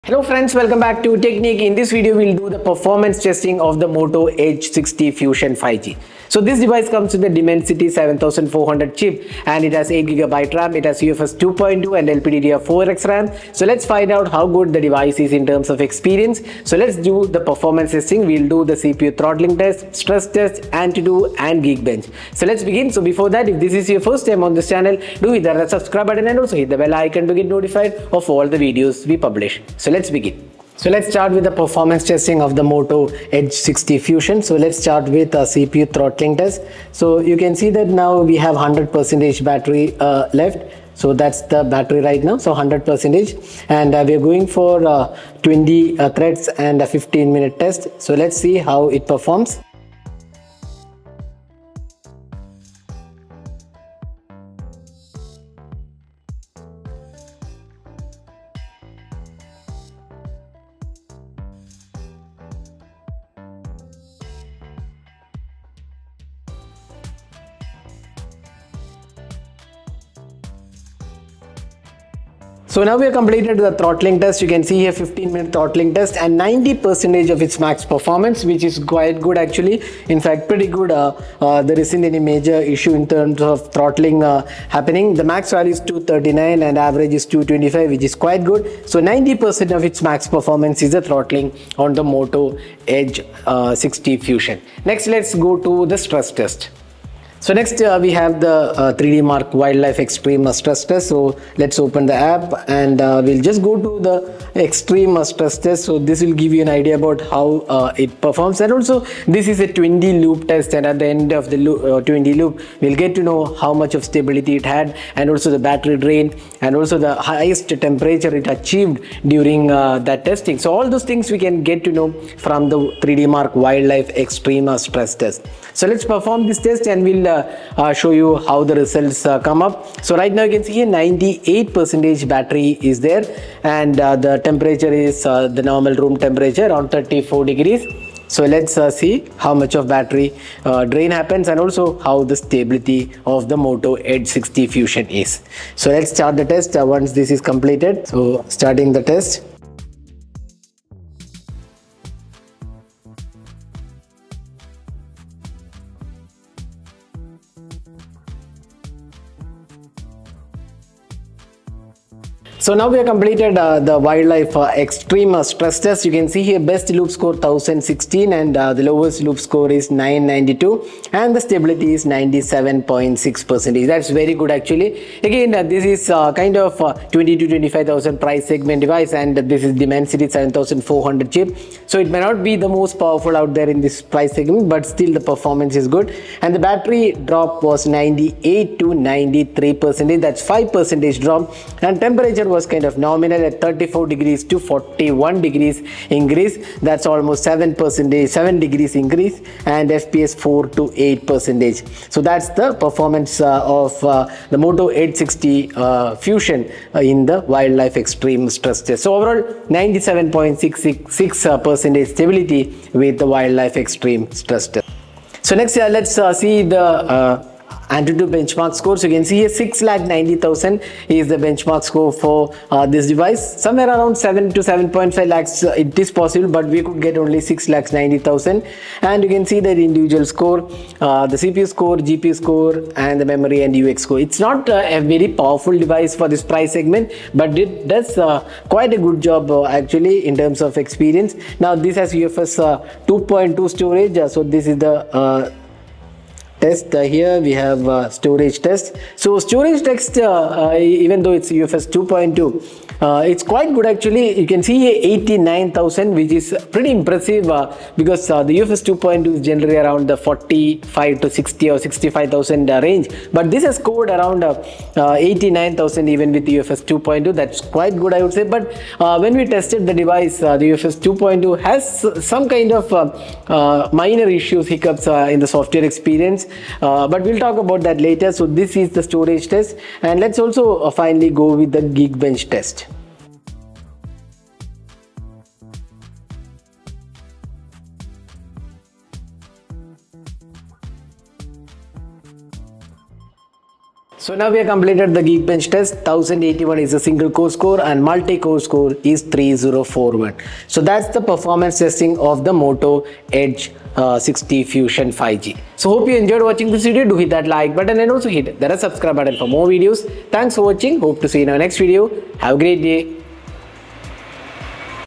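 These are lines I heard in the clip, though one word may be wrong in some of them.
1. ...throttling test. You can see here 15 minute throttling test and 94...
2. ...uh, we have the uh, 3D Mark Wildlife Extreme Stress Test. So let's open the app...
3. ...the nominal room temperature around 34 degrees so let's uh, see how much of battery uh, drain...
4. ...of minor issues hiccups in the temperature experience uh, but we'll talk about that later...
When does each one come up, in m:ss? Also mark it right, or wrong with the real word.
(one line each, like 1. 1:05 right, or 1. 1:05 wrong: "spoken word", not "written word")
1. 1:13 wrong: "90", not "94"
2. 1:37 right
3. 2:15 wrong: "normal", not "nominal"
4. 4:32 wrong: "software", not "temperature".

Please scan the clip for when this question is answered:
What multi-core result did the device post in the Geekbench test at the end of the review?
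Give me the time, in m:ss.
4:58.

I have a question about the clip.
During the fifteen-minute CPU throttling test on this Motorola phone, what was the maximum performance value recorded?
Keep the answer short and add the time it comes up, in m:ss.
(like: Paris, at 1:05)
239, at 1:25.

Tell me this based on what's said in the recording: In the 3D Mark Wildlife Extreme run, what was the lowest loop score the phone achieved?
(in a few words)
992.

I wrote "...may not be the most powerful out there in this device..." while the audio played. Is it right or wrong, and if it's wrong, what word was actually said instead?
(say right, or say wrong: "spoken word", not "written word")
wrong: "price", not "device".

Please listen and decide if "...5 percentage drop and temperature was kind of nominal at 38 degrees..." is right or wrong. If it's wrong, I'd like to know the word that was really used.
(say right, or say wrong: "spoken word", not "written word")
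wrong: "34", not "38".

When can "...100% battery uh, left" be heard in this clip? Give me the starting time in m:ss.
0:38.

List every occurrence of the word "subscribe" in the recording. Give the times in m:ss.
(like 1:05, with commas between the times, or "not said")
0:25, 5:08.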